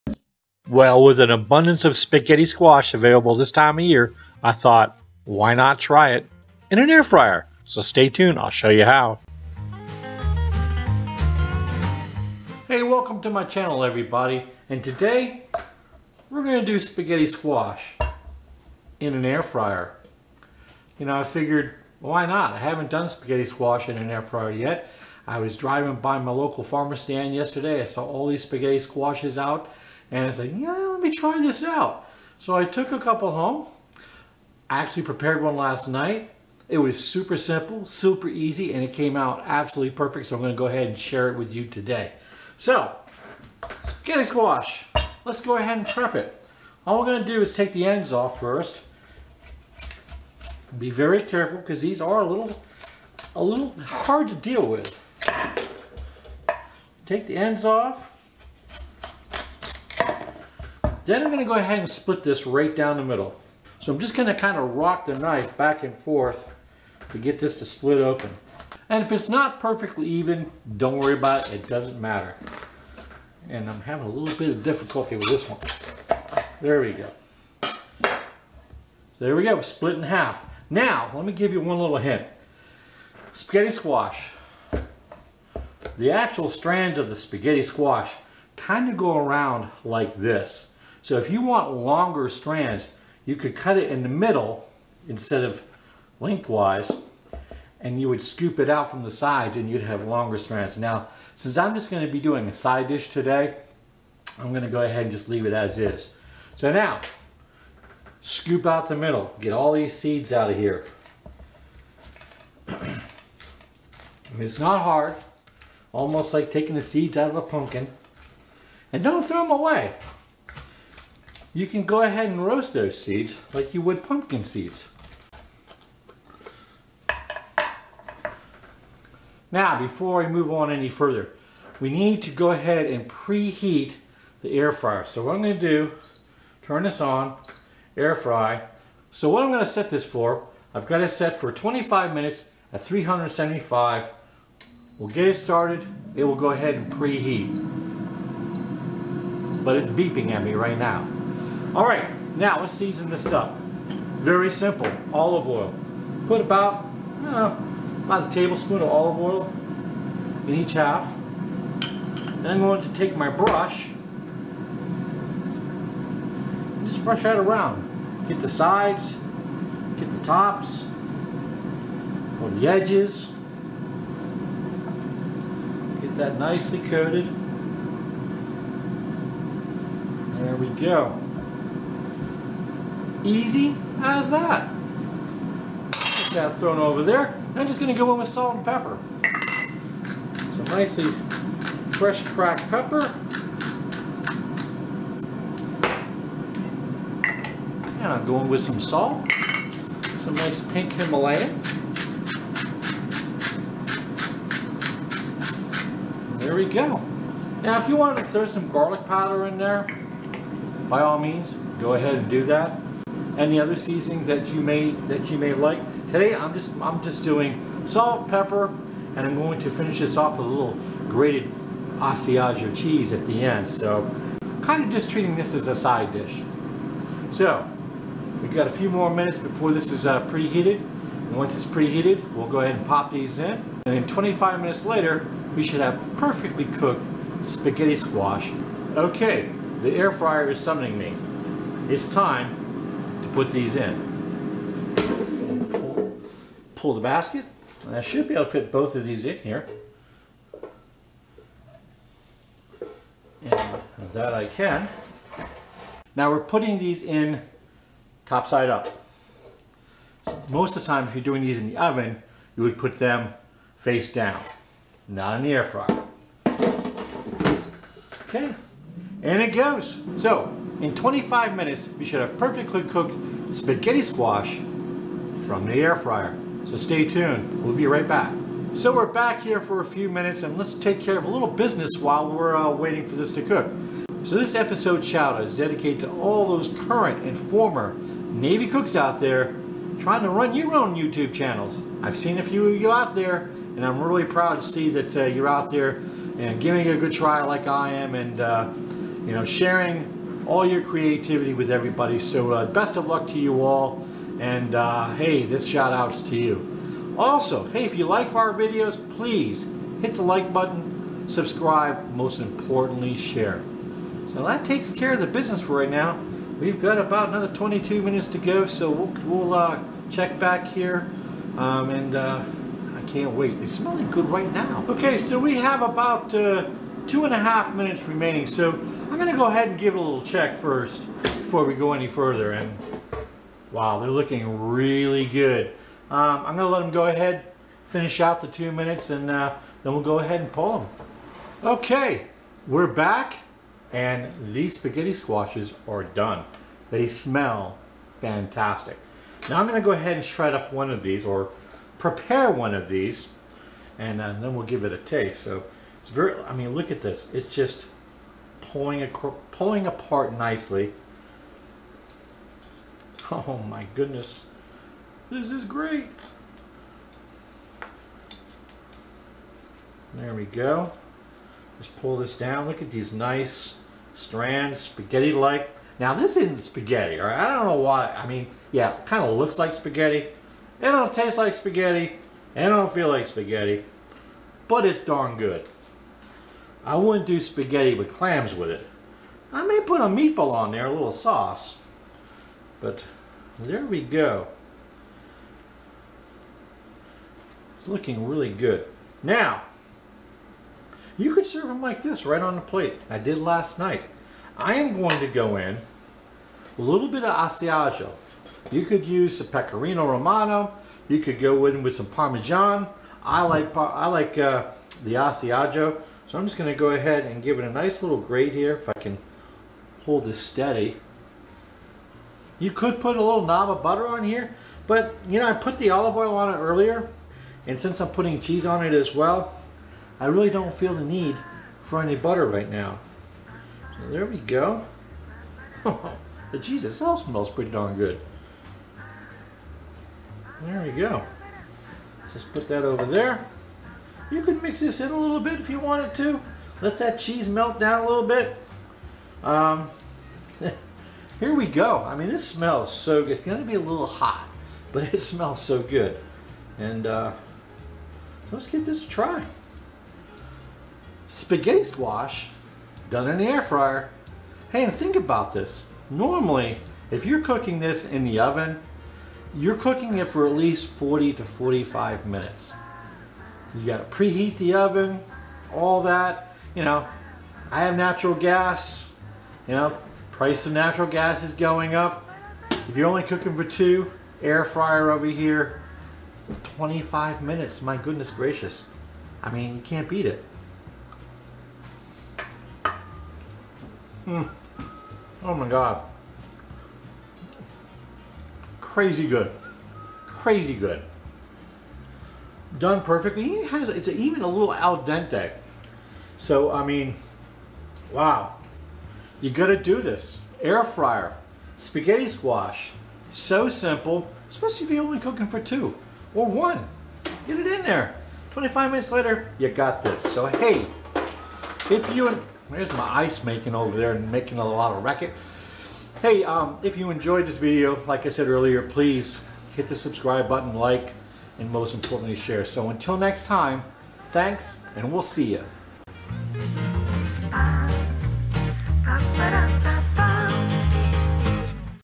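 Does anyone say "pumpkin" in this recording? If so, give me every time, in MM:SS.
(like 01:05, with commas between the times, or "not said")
01:57, 02:04.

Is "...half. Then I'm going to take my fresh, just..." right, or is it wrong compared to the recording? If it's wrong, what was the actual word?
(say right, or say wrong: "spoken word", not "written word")
wrong: "brush", not "fresh".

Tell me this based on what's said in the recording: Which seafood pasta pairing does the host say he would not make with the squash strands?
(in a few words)
spaghetti with clams.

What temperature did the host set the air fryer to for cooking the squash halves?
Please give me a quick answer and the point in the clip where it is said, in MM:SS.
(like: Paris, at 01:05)
375, at 02:22.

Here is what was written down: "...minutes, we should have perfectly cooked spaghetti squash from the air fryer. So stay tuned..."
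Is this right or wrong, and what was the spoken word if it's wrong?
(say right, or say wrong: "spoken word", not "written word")
right.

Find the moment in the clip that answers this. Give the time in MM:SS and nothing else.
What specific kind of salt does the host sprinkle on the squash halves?
03:20.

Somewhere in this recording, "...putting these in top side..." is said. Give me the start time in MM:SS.
04:16.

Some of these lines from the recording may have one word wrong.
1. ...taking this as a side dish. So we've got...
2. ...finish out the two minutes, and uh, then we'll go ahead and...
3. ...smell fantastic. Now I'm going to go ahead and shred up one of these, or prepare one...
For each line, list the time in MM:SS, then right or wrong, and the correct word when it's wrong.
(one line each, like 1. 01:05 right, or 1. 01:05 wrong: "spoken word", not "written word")
1. 03:45 wrong: "treating", not "taking"
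2. 05:37 right
3. 05:47 right.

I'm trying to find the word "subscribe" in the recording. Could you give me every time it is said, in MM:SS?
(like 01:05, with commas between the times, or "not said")
05:11, 08:49.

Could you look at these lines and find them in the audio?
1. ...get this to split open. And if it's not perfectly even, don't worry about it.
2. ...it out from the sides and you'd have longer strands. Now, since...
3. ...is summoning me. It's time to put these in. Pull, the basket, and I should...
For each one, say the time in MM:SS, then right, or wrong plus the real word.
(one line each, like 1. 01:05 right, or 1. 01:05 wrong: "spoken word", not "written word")
1. 01:07 right
2. 01:38 right
3. 04:00 right.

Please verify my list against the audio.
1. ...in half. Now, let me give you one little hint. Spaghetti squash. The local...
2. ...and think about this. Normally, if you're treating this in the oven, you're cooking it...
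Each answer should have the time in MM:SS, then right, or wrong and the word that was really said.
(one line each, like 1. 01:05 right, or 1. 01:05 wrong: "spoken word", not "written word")
1. 01:19 wrong: "actual", not "local"
2. 07:44 wrong: "cooking", not "treating".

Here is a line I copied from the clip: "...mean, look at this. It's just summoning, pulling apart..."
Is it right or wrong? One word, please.
wrong.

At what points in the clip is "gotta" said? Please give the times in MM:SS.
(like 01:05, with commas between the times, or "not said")
07:53, 08:29.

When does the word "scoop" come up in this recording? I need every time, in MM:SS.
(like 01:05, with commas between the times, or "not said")
01:38, 01:48.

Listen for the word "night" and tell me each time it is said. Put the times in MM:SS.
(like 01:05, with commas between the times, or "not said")
00:35, 06:43.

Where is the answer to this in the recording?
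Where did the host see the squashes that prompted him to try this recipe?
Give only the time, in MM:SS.
00:26.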